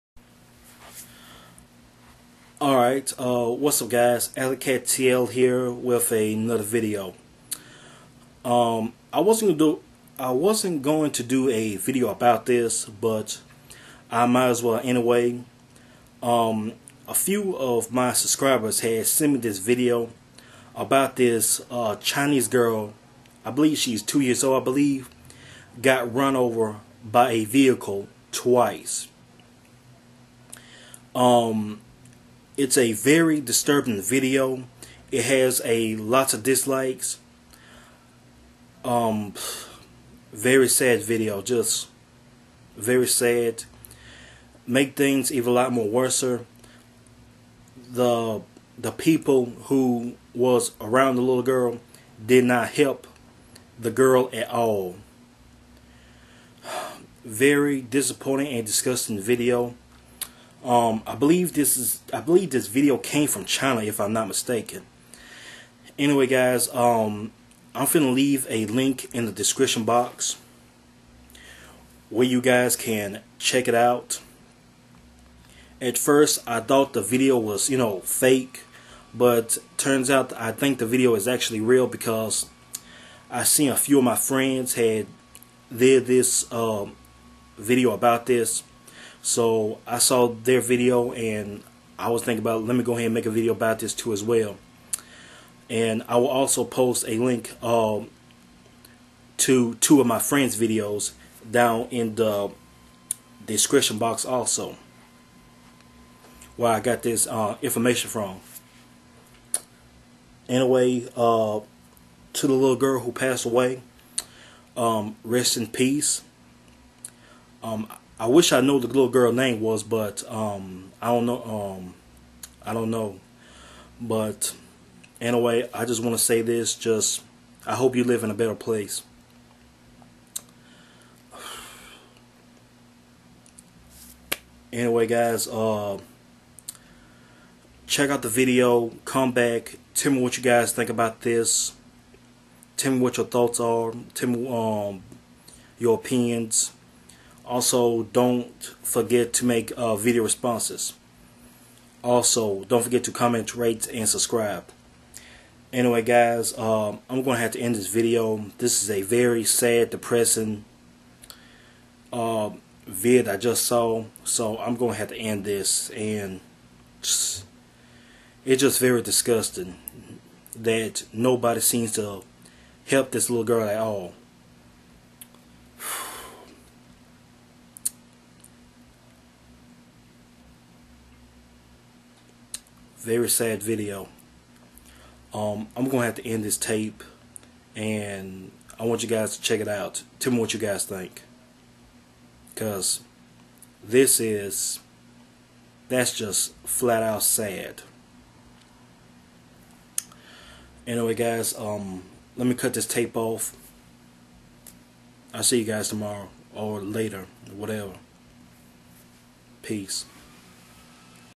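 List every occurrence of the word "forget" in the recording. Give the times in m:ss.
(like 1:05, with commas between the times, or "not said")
2:28, 2:32.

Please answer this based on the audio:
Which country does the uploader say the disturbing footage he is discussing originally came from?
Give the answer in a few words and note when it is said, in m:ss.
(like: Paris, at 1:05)
China, at 1:03.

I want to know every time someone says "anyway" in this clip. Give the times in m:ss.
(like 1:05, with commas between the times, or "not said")
0:14, 1:05, 1:50, 2:05, 2:14, 2:35, 3:20.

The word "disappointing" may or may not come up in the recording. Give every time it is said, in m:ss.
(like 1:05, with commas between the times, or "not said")
0:57.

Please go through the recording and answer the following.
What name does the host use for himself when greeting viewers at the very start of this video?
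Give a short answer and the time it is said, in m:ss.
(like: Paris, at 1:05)
Alley Cat TL, at 0:04.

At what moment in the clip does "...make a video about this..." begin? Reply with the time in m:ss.
1:33.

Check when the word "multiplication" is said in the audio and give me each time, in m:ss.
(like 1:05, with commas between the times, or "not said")
not said.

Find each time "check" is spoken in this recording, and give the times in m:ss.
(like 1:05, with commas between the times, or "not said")
1:13, 2:17, 3:09.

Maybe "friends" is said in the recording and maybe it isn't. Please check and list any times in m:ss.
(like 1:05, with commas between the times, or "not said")
1:24, 1:40.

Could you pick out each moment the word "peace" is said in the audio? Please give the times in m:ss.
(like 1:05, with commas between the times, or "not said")
1:55, 3:29.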